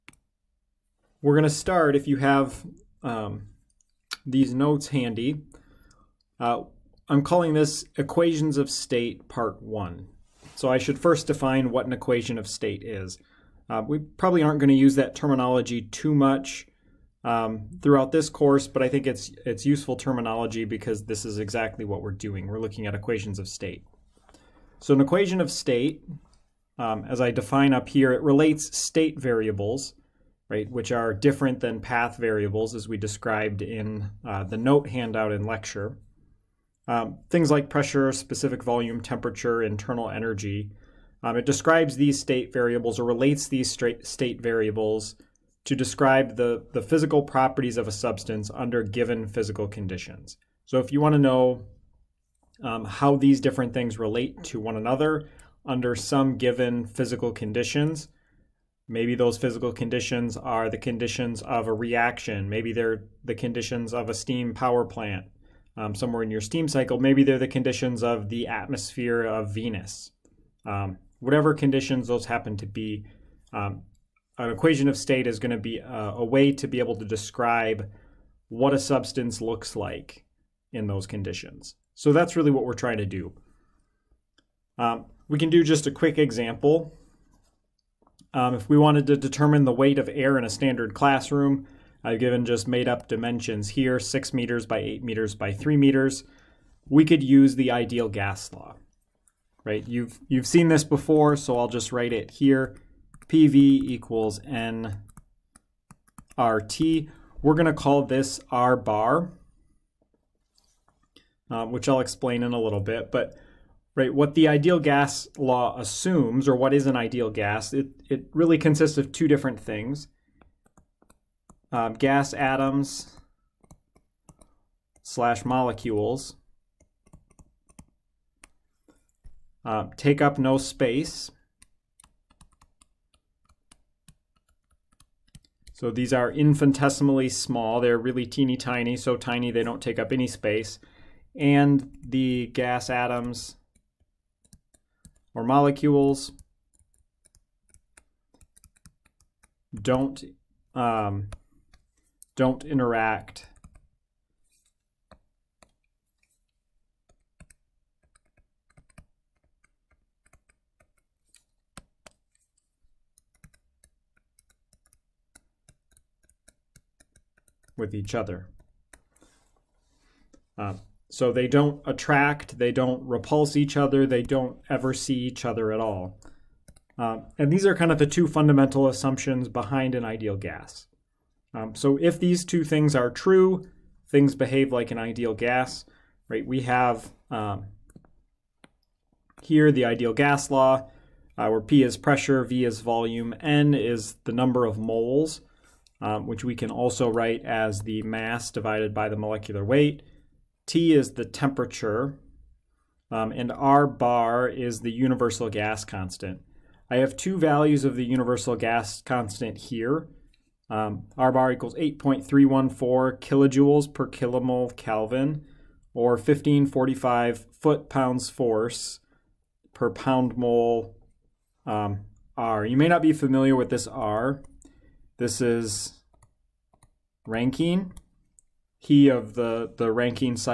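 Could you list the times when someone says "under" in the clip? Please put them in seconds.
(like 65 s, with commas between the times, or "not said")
48 s, 55 s.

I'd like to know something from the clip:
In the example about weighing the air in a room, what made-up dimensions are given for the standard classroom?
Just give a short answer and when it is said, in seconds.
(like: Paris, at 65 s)
6 m by 8 m by 3 m, at 93 s.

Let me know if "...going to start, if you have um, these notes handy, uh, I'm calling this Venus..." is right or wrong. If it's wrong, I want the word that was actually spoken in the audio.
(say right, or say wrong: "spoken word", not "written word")
wrong: "Equations", not "Venus".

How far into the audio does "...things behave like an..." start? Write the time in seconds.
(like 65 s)
184 s.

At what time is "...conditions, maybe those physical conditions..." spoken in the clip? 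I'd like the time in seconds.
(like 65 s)
57 s.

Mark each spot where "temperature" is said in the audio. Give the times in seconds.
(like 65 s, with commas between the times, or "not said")
38 s, 201 s.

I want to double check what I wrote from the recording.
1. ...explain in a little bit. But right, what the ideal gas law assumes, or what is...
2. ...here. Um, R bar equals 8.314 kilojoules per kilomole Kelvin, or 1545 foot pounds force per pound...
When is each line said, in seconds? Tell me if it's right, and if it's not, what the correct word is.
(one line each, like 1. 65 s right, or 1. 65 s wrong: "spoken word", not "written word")
1. 111 s right
2. 209 s right.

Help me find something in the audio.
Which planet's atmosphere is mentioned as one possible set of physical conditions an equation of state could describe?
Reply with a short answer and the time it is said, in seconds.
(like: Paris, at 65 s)
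Venus, at 69 s.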